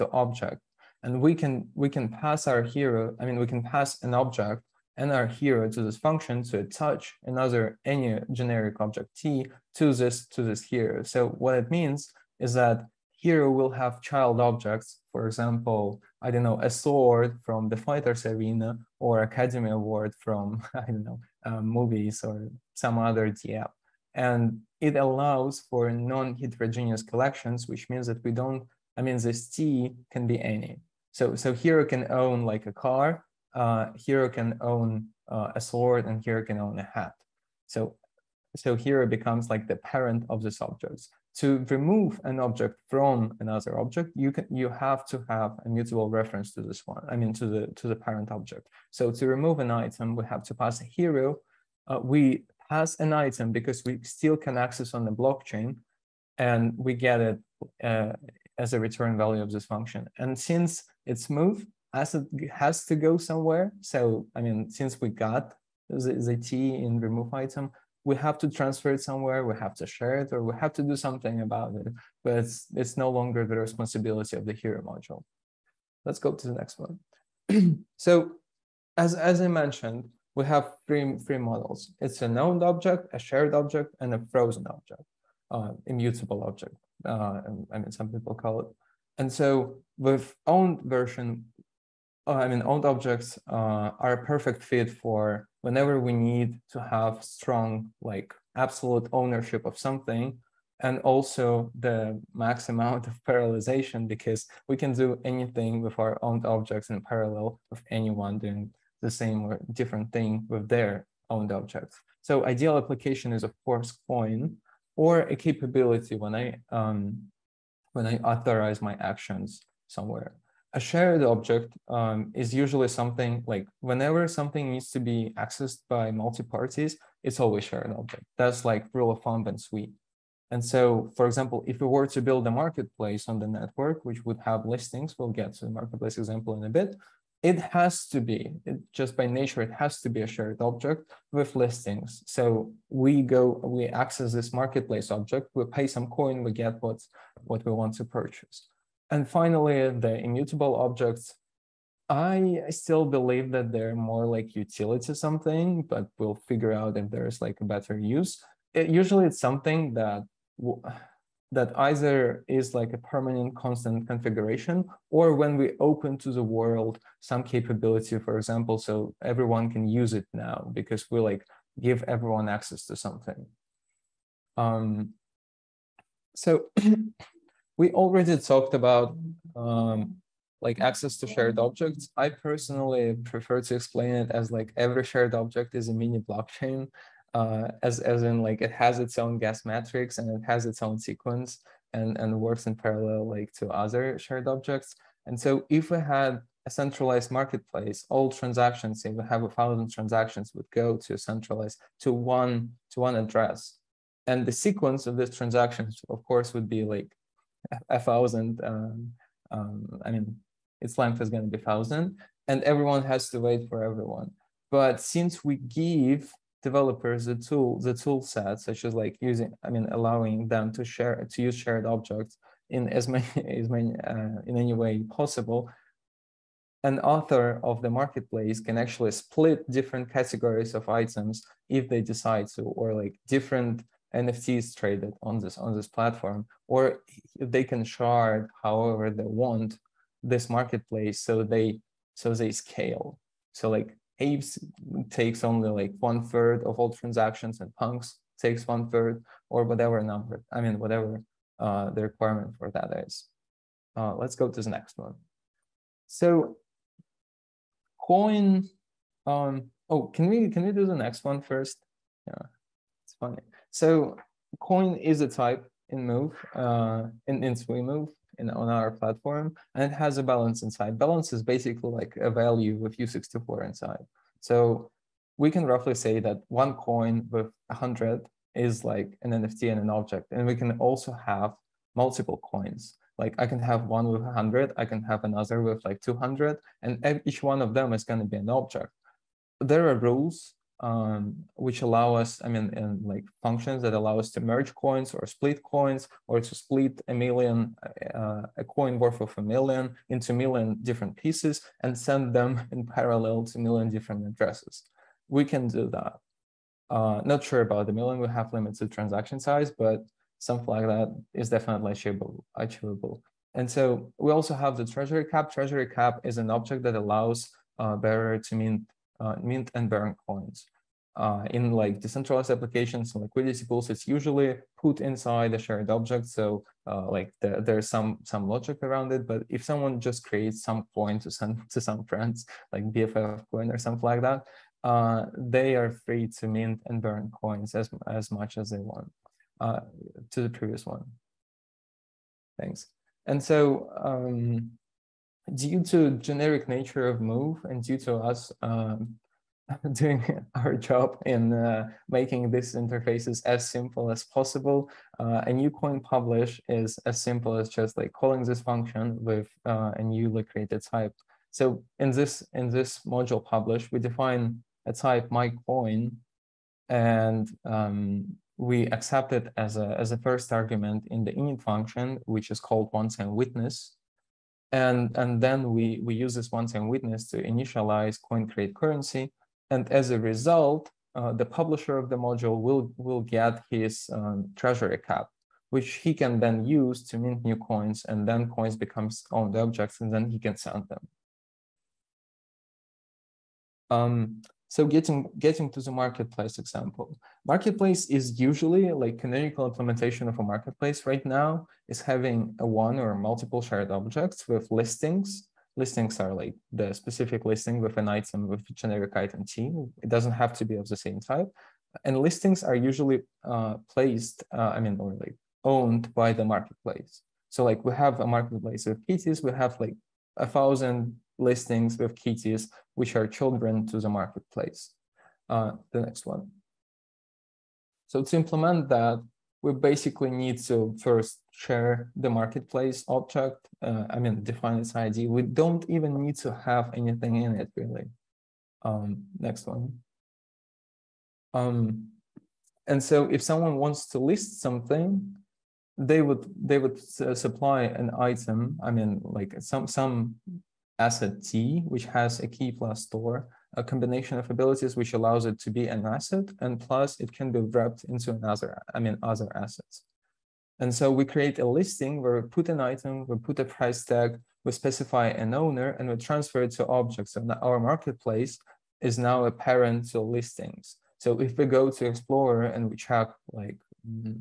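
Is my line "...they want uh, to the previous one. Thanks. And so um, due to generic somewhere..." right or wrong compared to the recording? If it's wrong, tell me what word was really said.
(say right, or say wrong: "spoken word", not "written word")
wrong: "nature", not "somewhere".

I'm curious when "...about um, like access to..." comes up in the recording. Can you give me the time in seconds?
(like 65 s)
178 s.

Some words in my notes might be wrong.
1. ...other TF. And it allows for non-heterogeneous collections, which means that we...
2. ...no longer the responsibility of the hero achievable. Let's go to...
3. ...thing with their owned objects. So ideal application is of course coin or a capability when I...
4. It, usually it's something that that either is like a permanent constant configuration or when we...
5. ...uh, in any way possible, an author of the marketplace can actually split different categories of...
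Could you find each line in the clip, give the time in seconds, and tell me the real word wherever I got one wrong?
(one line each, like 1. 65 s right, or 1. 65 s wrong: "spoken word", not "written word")
1. 22 s right
2. 72 s wrong: "module", not "achievable"
3. 110 s right
4. 158 s right
5. 224 s right.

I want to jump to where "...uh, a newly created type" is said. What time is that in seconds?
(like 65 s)
359 s.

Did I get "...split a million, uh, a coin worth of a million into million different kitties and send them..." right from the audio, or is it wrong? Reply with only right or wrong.
wrong.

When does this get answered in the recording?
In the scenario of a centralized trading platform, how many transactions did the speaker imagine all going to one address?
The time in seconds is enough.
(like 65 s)
199 s.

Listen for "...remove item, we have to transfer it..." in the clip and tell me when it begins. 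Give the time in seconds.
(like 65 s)
66 s.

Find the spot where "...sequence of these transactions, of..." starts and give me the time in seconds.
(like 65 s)
204 s.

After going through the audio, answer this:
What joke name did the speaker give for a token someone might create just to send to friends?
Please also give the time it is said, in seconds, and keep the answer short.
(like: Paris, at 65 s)
BFF coin, at 332 s.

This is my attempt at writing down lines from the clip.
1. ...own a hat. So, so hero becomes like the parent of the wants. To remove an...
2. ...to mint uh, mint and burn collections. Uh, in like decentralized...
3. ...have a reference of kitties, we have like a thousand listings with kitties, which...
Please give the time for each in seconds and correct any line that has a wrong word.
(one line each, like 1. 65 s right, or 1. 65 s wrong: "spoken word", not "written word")
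1. 36 s wrong: "objects", not "wants"
2. 318 s wrong: "coins", not "collections"
3. 417 s wrong: "marketplace", not "reference".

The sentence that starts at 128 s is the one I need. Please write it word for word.
That's like rule of thumb and Sui.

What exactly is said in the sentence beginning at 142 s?
So we go, we access this marketplace object, we pay some coin, we get what, what we want to purchase.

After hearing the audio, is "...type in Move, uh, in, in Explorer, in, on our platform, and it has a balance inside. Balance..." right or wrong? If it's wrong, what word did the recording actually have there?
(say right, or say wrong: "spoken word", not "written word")
wrong: "Move", not "Explorer".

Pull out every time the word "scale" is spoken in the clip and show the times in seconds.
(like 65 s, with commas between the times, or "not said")
242 s.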